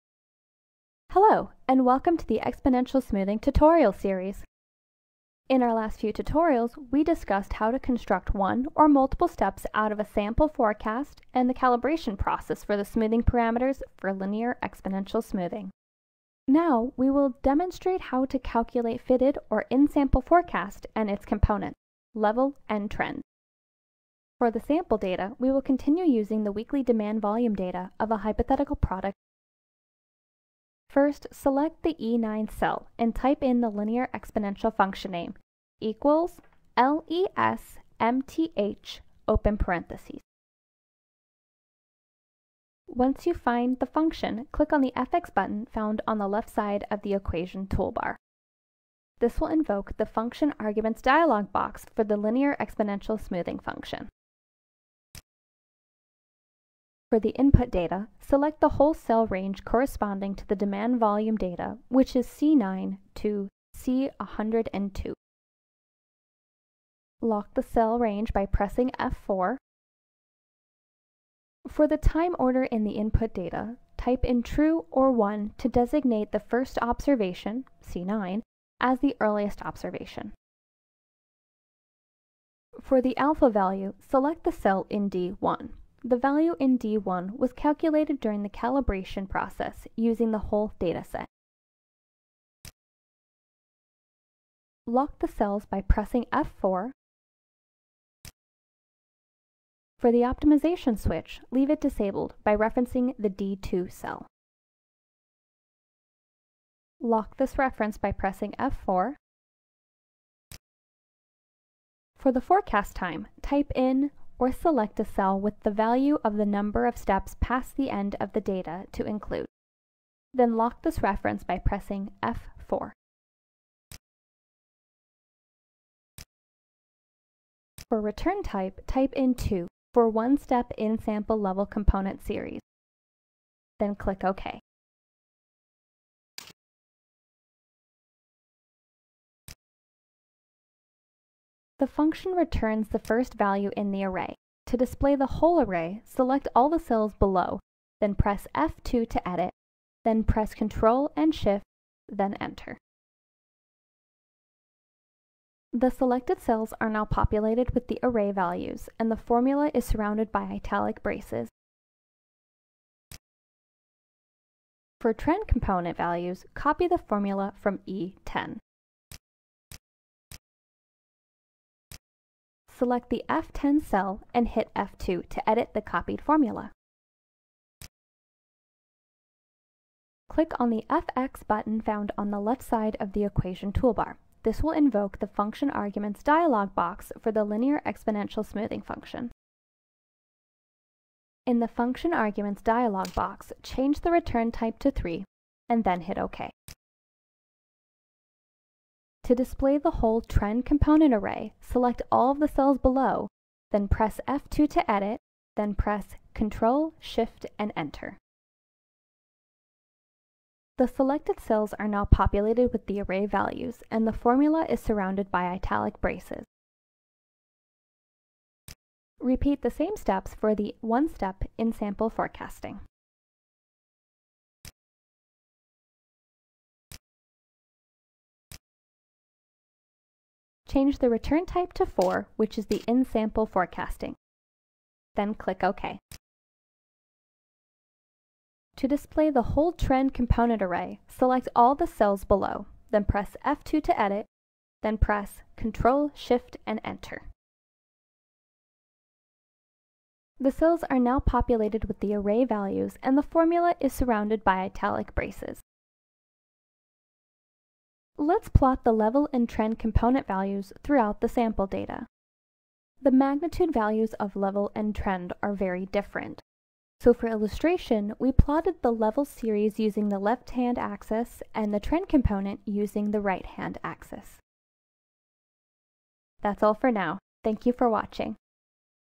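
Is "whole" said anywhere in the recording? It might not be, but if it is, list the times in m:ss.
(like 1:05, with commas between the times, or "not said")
0:58, 1:30, 2:25, 3:19, 3:59.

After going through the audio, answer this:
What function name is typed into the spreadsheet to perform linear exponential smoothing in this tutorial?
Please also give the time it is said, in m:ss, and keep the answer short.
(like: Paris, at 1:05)
LESMTH, at 0:36.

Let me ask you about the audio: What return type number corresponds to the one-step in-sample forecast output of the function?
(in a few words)
4.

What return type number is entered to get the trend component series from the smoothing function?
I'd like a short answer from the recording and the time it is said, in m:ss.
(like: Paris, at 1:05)
3, at 3:14.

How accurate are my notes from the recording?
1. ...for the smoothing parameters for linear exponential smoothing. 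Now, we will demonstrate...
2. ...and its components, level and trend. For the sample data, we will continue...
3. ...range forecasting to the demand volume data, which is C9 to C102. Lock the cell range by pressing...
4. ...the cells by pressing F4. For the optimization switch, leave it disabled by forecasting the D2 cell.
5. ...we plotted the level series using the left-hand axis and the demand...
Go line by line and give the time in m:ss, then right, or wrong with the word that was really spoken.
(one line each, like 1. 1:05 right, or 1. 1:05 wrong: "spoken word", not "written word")
1. 0:12 right
2. 0:20 right
3. 0:59 wrong: "corresponding", not "forecasting"
4. 1:35 wrong: "referencing", not "forecasting"
5. 4:28 wrong: "trend", not "demand".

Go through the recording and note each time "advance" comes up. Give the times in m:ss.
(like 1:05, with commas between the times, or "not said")
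not said.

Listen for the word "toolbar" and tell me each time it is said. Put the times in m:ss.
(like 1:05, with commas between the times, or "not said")
0:47, 3:03.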